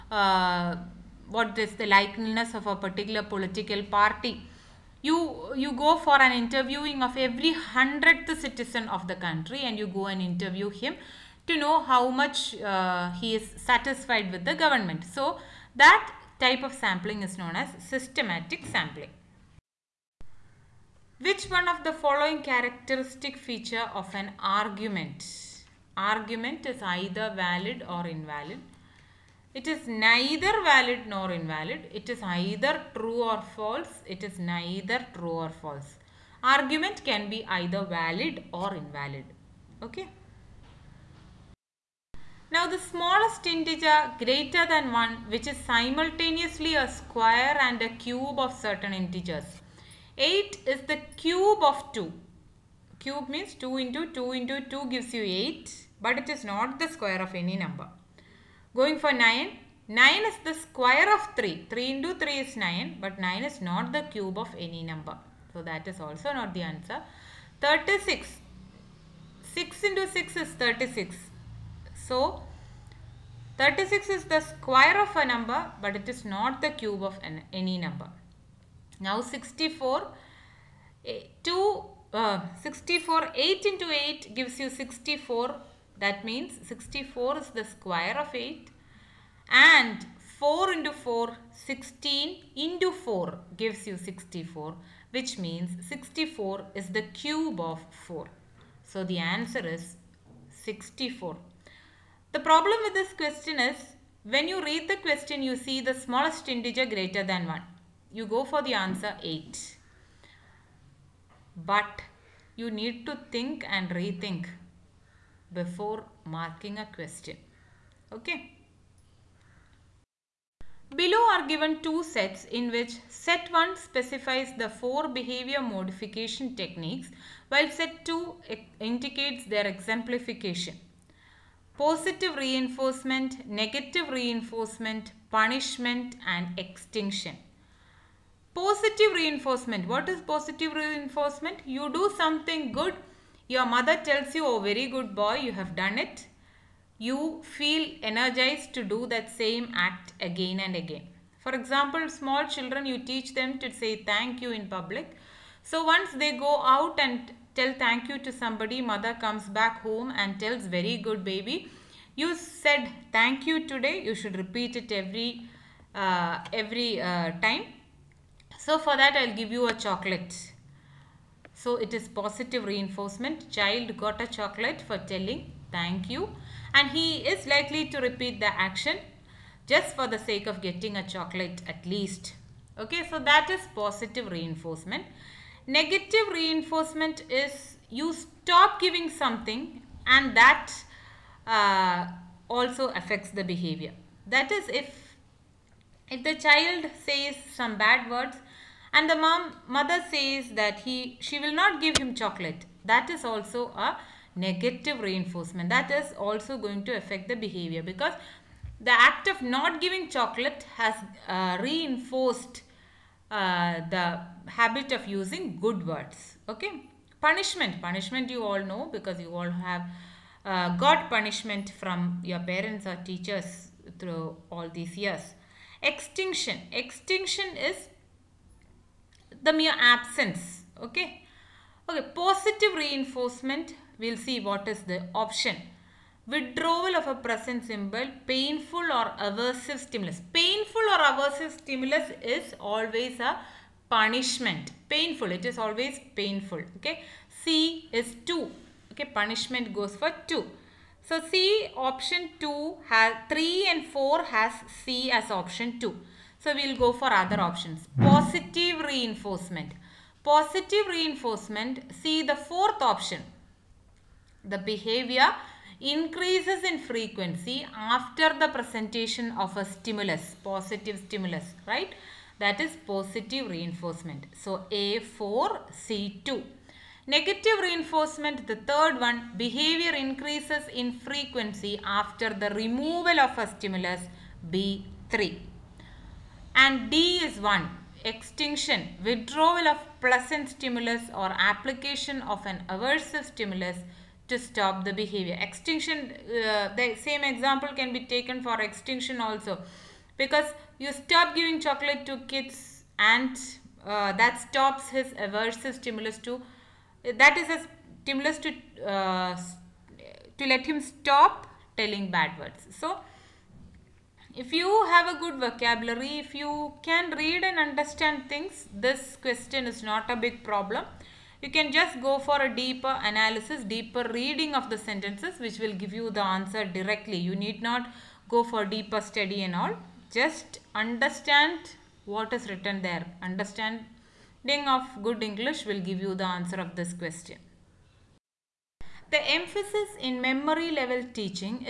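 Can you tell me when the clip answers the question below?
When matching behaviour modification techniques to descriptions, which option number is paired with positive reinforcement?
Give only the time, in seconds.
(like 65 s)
274 s.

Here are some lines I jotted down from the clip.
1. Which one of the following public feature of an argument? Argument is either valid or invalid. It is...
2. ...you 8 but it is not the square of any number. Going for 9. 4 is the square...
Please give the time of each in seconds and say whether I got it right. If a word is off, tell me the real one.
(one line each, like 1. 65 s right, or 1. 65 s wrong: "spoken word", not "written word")
1. 21 s wrong: "characteristic", not "public"
2. 55 s wrong: "9", not "4".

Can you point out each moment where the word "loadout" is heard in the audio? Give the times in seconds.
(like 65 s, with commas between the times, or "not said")
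not said.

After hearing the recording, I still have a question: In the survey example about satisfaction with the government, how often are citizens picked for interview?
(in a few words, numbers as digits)
every 100th citizen.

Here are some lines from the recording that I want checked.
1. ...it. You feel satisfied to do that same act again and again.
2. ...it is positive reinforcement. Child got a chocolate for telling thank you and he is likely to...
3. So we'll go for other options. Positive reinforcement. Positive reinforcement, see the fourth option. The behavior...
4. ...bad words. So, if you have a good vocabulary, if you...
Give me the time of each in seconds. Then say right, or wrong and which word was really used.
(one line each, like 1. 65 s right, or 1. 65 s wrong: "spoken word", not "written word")
1. 145 s wrong: "energized", not "satisfied"
2. 171 s right
3. 256 s right
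4. 312 s right.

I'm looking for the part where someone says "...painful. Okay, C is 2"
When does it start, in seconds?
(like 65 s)
246 s.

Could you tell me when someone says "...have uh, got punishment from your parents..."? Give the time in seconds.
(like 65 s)
219 s.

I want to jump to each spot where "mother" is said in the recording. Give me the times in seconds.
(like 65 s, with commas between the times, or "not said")
143 s, 158 s, 199 s.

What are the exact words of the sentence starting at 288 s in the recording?
Extinction, withdrawal of pleasant stimulus or application of an aversive stimulus to stop the behavior.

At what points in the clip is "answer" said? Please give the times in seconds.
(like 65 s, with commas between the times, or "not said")
66 s, 99 s, 108 s, 326 s, 336 s.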